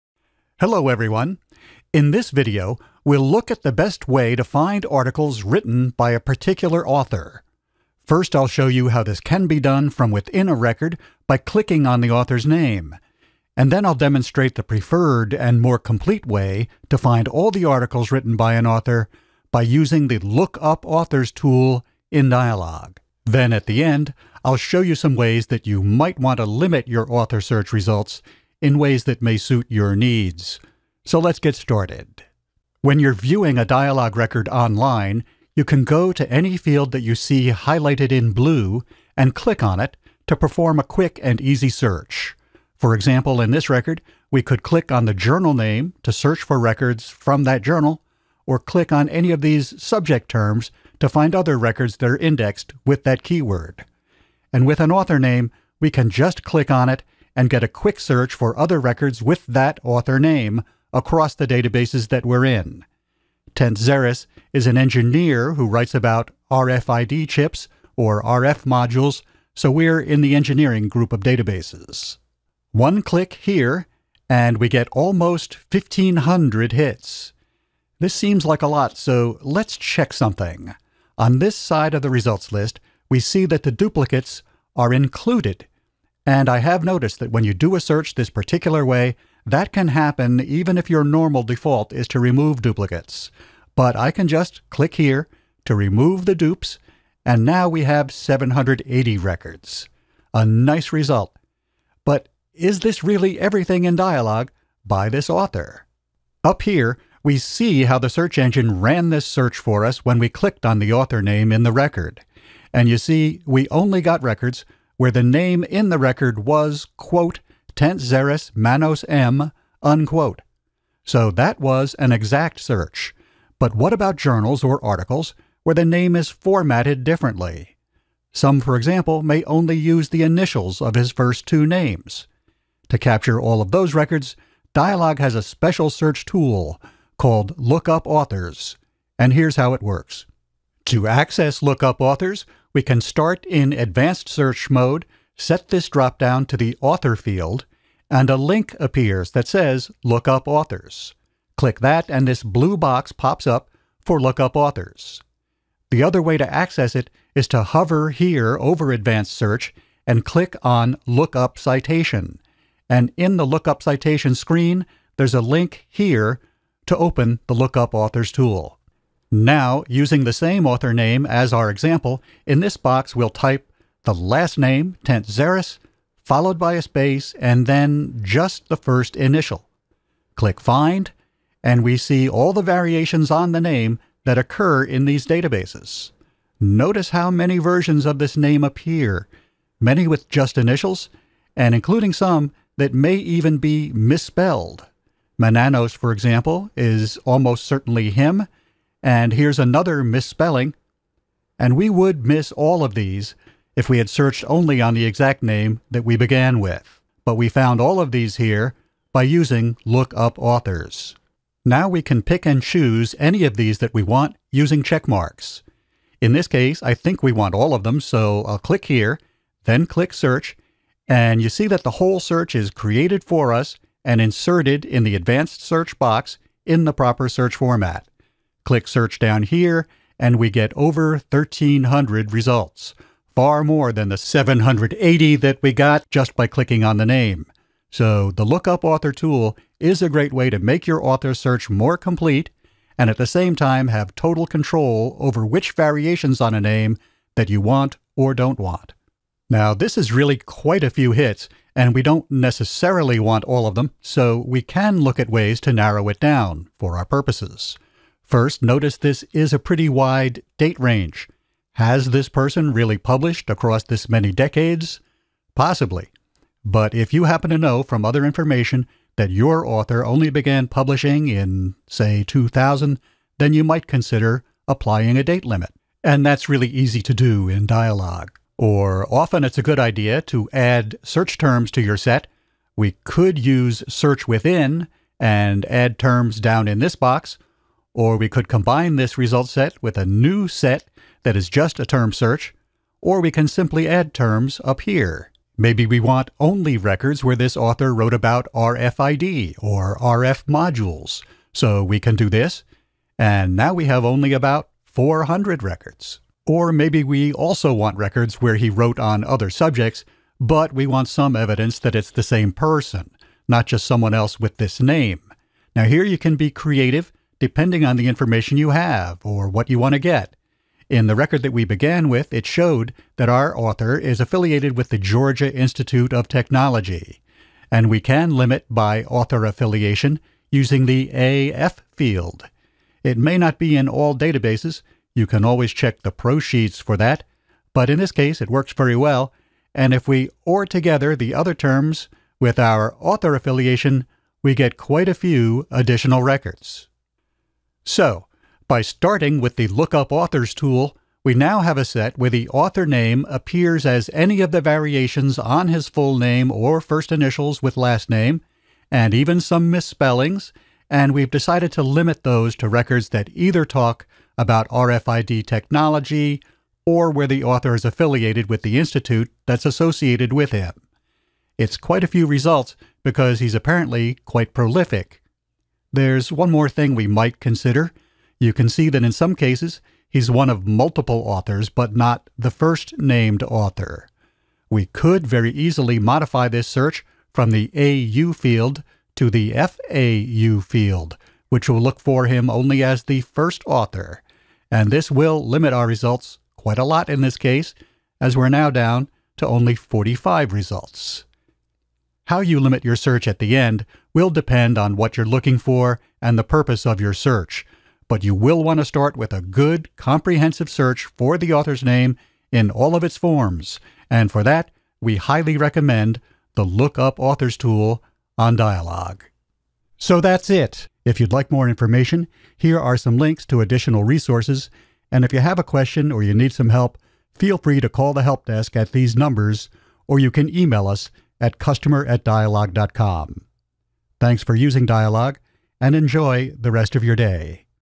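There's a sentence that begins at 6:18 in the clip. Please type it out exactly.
You can see that in some cases, he's one of multiple authors, but not the first named author.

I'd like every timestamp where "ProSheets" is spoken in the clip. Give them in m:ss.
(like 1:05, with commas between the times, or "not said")
5:36.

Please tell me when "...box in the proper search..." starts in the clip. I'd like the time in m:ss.
3:45.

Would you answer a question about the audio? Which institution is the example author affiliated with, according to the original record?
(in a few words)
Georgia Institute of Technology.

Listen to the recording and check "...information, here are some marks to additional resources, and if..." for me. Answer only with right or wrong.
wrong.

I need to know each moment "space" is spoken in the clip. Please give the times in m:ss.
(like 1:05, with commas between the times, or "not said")
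2:56.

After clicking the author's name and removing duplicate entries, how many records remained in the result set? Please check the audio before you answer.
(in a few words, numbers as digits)
780.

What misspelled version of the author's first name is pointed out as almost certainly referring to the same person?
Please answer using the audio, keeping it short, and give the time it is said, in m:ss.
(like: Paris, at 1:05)
Mananos, at 3:15.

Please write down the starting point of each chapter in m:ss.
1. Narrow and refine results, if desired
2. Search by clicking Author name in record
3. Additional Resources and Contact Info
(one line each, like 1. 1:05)
1. 4:09
2. 0:32
3. 7:00.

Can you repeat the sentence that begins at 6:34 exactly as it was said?
And this will limit our results quite a lot in this case, as we're now down to only 45 results.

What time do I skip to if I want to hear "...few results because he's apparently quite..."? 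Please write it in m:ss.
6:12.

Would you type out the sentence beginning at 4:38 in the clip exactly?
Or often it's a good idea to add search terms to your set.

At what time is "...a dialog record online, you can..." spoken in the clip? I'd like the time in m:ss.
0:33.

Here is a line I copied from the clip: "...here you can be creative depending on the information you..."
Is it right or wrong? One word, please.
right.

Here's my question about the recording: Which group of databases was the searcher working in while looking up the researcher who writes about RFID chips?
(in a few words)
engineering.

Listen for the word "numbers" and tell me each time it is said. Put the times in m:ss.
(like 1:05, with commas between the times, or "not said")
7:09.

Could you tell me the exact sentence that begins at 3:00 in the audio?
Click Find, and we see all the variations on the name that occur in these databases.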